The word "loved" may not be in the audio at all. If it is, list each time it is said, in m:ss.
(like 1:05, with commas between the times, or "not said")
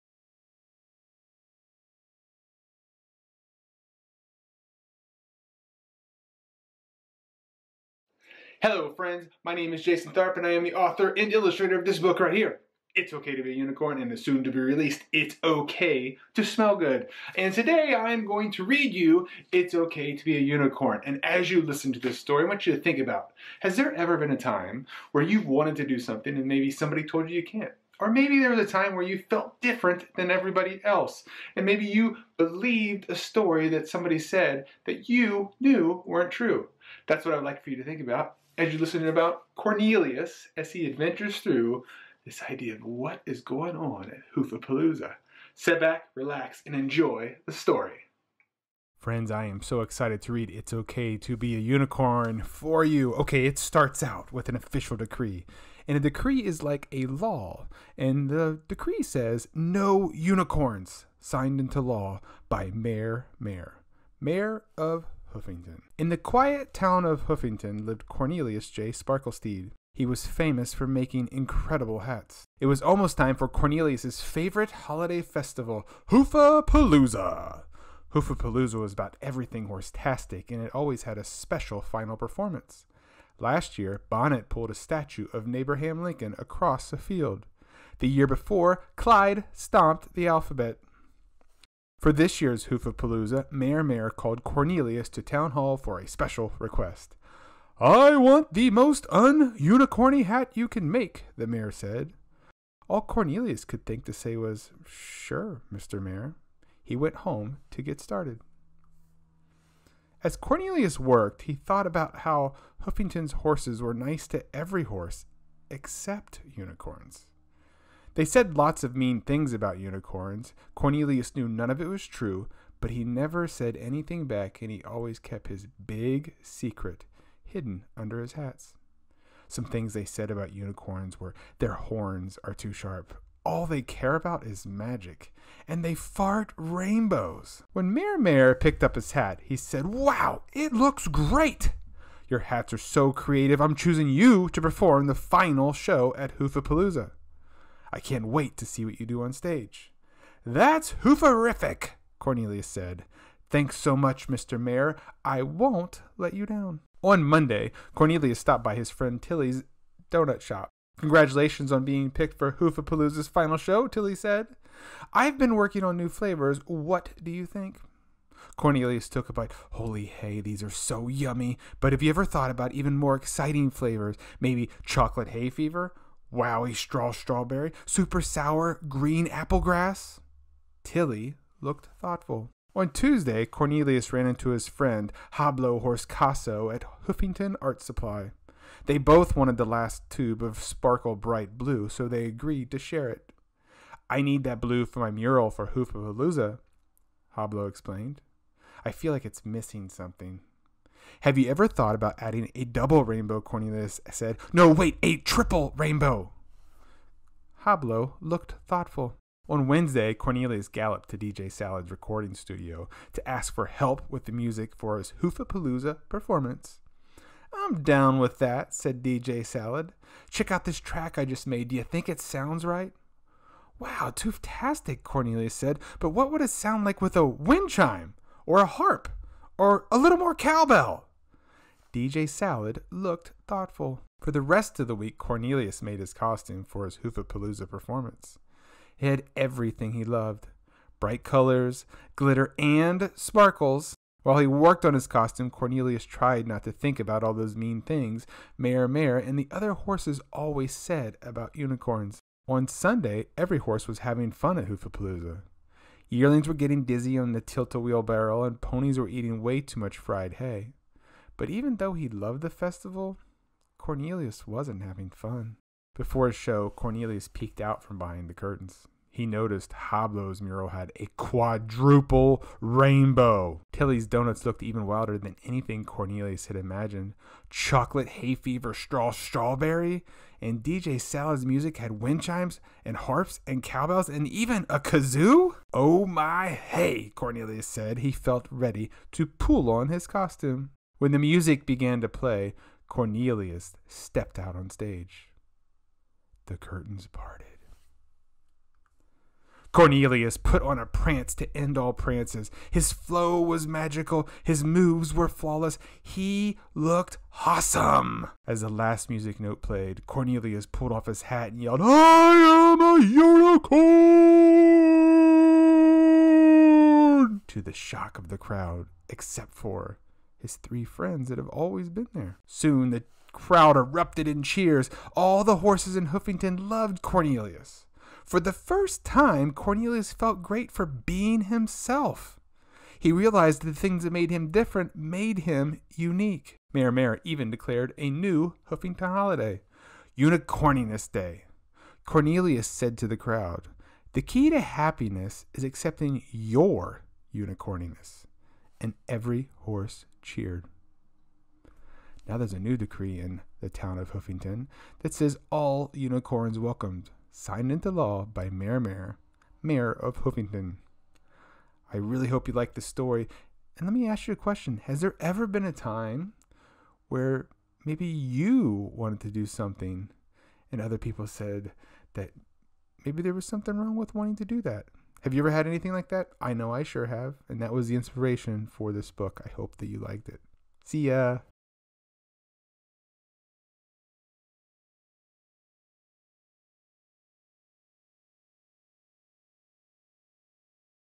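4:00, 4:22, 5:26.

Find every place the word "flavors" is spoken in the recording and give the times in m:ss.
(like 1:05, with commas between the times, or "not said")
2:46, 2:53.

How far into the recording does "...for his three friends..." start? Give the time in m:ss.
5:19.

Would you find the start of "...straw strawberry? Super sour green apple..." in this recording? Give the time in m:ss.
2:56.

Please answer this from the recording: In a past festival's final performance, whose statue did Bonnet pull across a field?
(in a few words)
Abraham Lincoln.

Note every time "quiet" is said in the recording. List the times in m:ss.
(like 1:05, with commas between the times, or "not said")
1:06.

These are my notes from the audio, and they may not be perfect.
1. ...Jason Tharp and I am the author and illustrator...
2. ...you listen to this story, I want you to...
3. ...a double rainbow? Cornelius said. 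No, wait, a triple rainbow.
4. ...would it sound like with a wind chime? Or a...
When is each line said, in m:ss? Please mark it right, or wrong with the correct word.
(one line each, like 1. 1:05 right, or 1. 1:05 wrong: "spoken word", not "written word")
1. 0:09 right
2. 0:21 right
3. 3:22 right
4. 3:46 right.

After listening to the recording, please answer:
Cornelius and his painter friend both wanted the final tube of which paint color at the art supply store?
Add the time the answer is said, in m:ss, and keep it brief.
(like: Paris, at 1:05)
Sparkle bright blue, at 3:10.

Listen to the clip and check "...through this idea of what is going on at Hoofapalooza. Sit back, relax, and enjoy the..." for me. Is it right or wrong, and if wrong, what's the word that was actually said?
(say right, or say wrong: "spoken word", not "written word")
right.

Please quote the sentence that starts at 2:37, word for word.
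On Monday, Cornelius stopped by his friend Tilly's donut shop.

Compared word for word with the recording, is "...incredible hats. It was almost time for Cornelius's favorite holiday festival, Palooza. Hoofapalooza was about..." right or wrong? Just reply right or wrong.
right.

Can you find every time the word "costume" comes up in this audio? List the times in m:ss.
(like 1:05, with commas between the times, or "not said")
3:56, 4:05, 4:50.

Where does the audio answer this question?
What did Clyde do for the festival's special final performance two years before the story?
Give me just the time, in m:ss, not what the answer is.
1:29.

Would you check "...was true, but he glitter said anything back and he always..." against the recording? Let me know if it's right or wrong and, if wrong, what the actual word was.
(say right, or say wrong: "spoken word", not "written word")
wrong: "never", not "glitter".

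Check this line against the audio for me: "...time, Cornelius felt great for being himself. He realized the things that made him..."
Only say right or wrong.
right.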